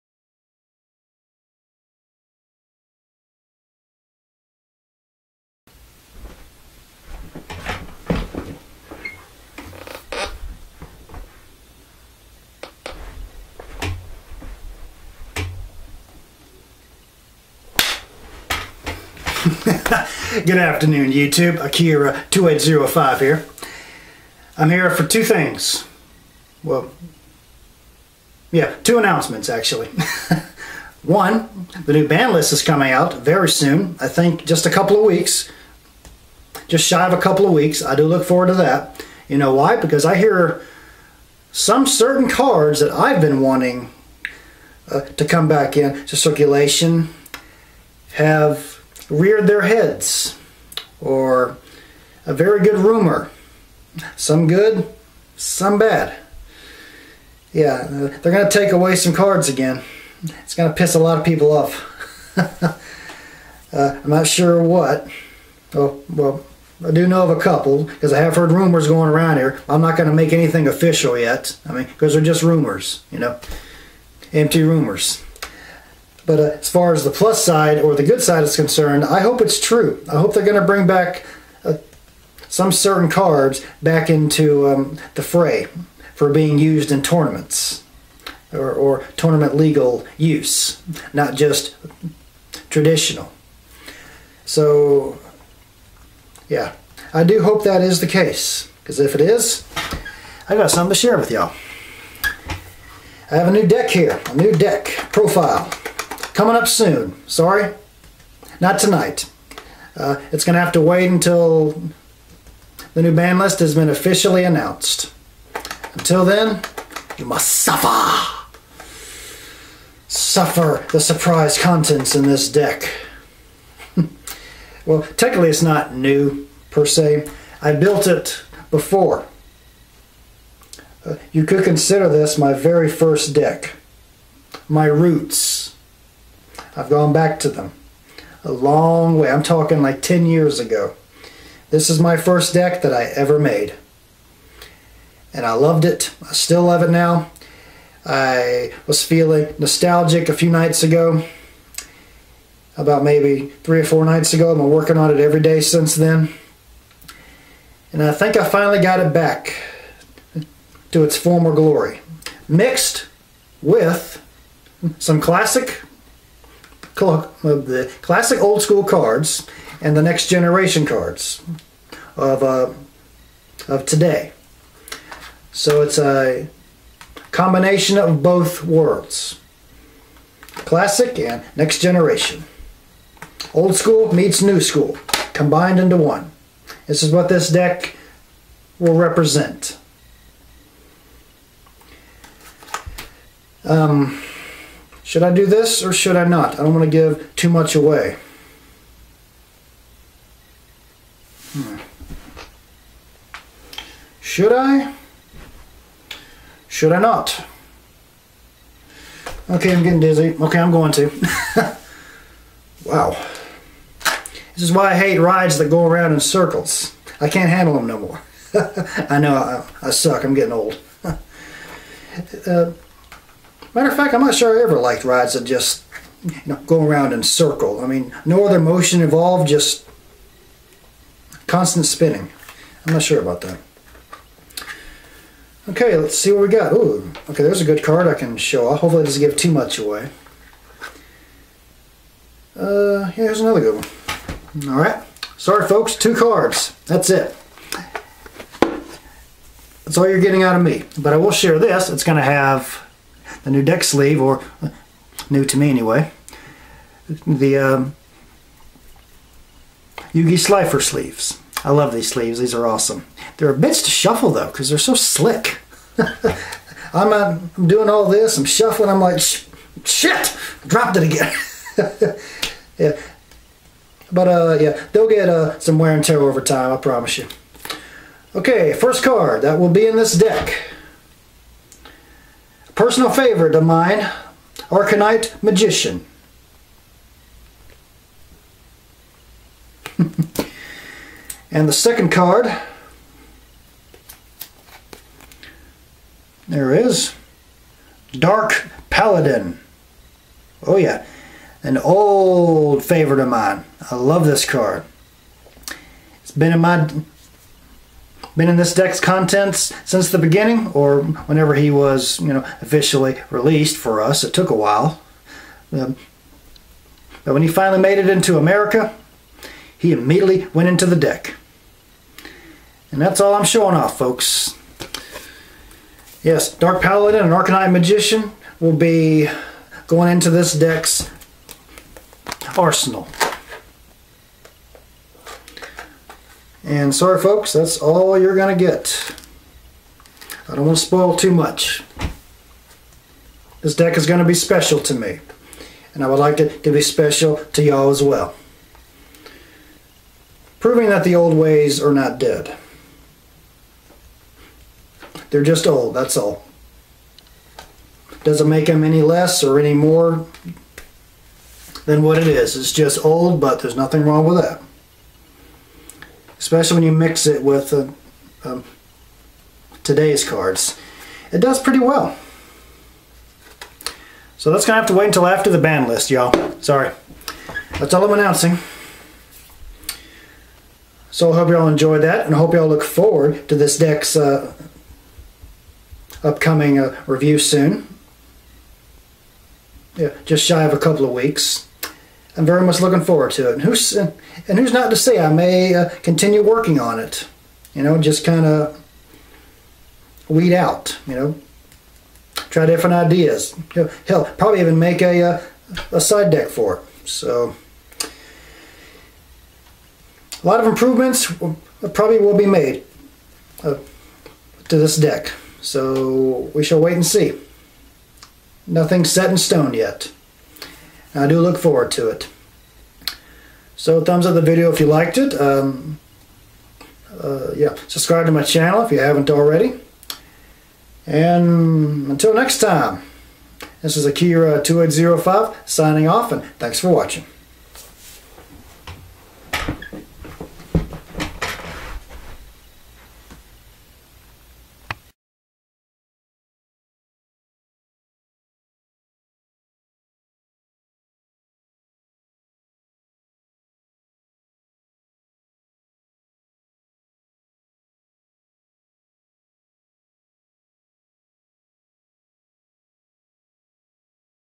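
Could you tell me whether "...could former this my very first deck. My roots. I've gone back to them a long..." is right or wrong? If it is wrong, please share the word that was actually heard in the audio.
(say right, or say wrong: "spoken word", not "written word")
wrong: "consider", not "former".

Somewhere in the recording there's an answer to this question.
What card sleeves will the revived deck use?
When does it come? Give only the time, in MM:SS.
04:20.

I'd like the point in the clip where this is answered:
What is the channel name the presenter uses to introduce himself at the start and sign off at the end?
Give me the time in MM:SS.
00:21.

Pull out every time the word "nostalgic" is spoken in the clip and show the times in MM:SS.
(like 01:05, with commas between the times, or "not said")
02:29.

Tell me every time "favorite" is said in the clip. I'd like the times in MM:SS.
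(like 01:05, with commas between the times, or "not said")
04:43, 05:02.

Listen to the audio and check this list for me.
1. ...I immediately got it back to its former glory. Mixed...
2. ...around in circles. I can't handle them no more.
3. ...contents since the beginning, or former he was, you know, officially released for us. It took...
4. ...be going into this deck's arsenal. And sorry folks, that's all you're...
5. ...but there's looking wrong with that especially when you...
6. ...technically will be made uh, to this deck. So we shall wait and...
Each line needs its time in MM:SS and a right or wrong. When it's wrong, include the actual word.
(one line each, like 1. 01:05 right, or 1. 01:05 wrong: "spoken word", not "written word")
1. 02:38 wrong: "finally", not "immediately"
2. 03:35 right
3. 05:08 wrong: "whenever", not "former"
4. 05:28 right
5. 06:03 wrong: "nothing", not "looking"
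6. 06:51 wrong: "probably", not "technically".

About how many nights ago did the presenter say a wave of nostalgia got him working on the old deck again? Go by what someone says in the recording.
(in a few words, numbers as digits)
3 or 4.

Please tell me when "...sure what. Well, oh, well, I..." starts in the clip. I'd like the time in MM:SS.
01:04.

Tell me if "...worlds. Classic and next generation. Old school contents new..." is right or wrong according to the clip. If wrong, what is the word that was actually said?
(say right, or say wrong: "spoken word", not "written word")
wrong: "meets", not "contents".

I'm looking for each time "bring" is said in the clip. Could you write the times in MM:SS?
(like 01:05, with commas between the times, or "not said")
01:20.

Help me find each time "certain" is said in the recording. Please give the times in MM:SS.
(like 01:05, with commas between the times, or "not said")
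00:41, 01:22.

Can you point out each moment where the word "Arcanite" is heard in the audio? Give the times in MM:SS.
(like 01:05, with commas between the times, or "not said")
04:44, 05:27.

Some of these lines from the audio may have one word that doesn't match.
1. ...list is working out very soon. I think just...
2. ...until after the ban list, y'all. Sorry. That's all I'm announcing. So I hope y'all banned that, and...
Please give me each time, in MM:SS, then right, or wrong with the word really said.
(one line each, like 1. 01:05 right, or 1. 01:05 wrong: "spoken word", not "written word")
1. 00:32 wrong: "coming", not "working"
2. 06:15 wrong: "enjoyed", not "banned".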